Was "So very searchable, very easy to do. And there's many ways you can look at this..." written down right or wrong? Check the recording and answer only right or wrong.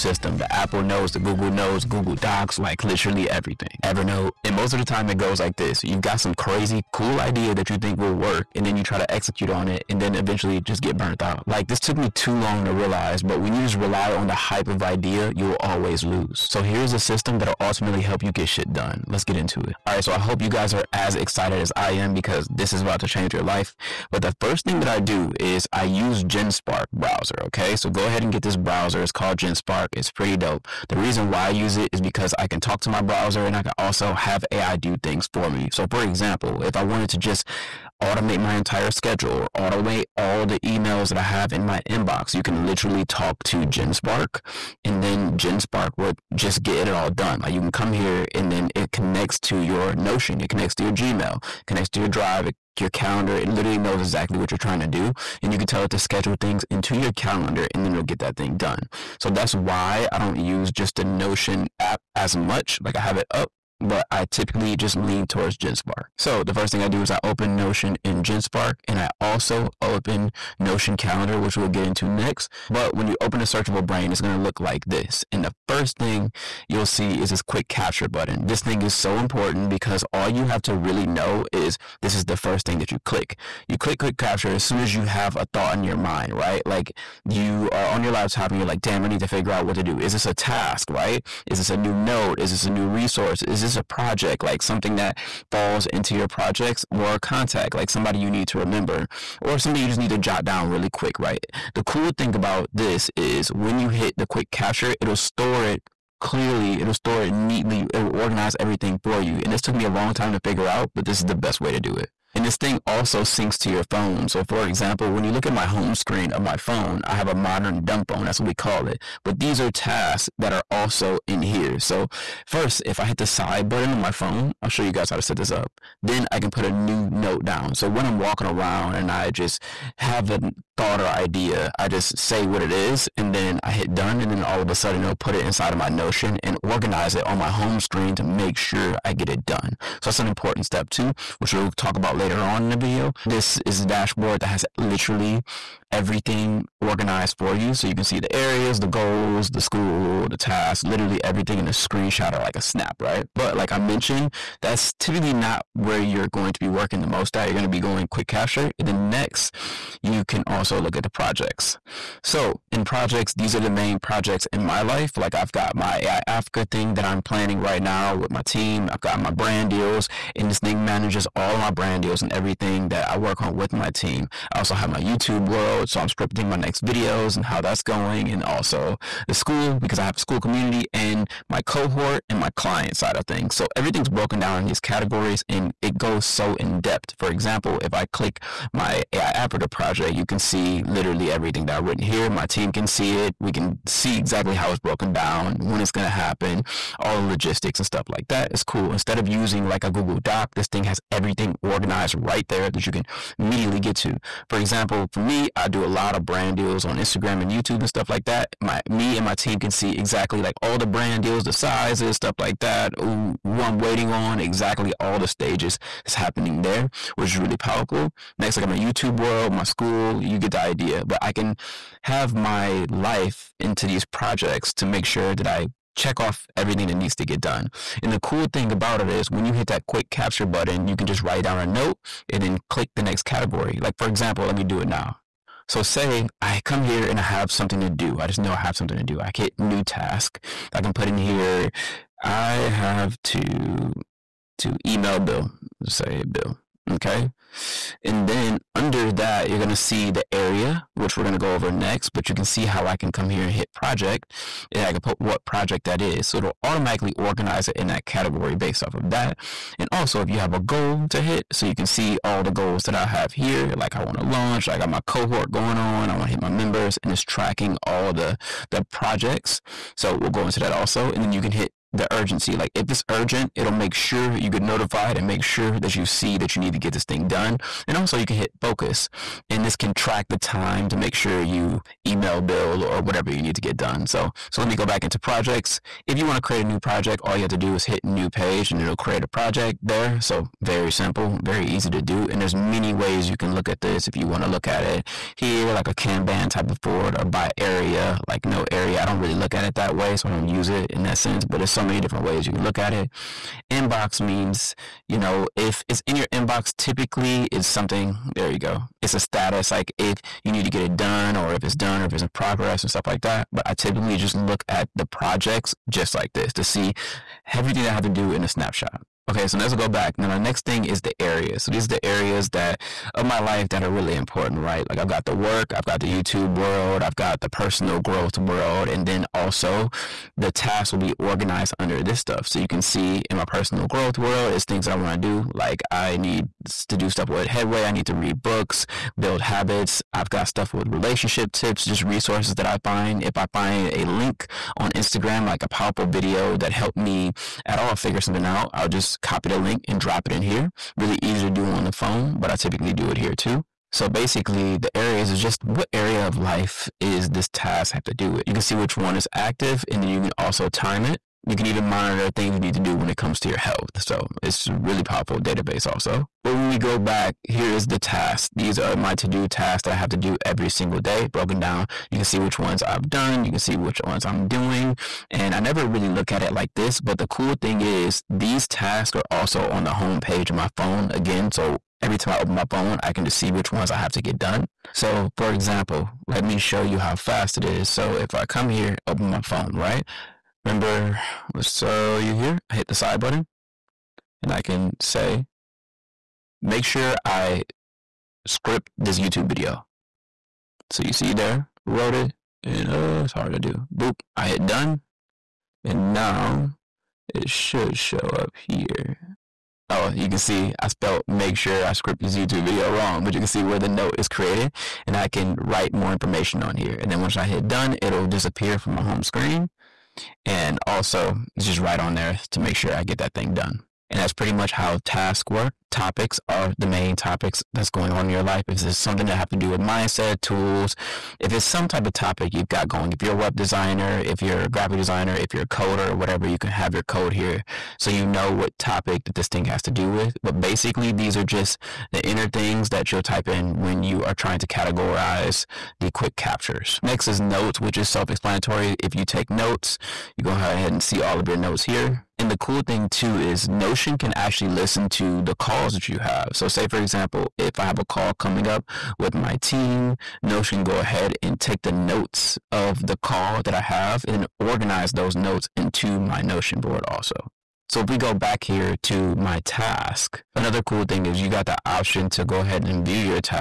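wrong.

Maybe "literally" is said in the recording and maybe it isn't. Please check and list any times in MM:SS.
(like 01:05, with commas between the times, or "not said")
00:02, 00:42, 00:53, 02:24, 02:30, 03:10.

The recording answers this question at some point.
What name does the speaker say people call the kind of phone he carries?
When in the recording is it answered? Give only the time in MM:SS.
01:57.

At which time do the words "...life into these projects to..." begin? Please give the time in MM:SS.
03:42.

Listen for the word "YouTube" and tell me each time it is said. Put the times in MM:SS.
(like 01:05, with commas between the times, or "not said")
02:54, 03:27, 03:38, 05:26, 06:39, 06:52.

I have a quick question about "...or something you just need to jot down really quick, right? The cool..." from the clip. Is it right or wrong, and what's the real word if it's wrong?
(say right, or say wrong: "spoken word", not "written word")
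right.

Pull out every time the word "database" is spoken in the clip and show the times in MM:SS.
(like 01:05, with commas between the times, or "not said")
06:05.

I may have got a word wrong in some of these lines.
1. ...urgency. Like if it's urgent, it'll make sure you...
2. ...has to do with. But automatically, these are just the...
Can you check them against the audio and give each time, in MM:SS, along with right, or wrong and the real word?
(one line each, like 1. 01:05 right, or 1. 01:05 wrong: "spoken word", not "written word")
1. 04:32 right
2. 07:19 wrong: "basically", not "automatically".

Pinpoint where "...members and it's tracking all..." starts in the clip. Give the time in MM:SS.
04:26.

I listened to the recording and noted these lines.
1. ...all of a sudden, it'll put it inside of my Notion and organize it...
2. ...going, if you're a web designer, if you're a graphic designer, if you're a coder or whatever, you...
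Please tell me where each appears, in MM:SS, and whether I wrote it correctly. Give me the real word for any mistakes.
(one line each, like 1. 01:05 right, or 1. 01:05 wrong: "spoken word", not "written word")
1. 02:14 right
2. 07:12 right.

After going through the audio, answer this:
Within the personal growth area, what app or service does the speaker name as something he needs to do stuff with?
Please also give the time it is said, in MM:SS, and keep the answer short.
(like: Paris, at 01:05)
Headway, at 05:37.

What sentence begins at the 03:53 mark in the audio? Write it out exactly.
Like, for example, let me do it now.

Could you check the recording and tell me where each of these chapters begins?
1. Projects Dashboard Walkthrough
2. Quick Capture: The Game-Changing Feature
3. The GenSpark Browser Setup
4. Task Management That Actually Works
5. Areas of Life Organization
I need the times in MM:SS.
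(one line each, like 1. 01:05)
1. 03:16
2. 01:41
3. 00:26
4. 06:26
5. 05:11.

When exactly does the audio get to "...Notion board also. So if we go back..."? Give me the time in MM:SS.
07:46.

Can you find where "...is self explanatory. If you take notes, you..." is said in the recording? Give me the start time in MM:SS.
07:27.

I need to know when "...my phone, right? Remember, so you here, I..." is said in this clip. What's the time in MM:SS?
06:29.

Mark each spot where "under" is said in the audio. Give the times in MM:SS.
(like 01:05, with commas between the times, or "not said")
04:08, 05:31.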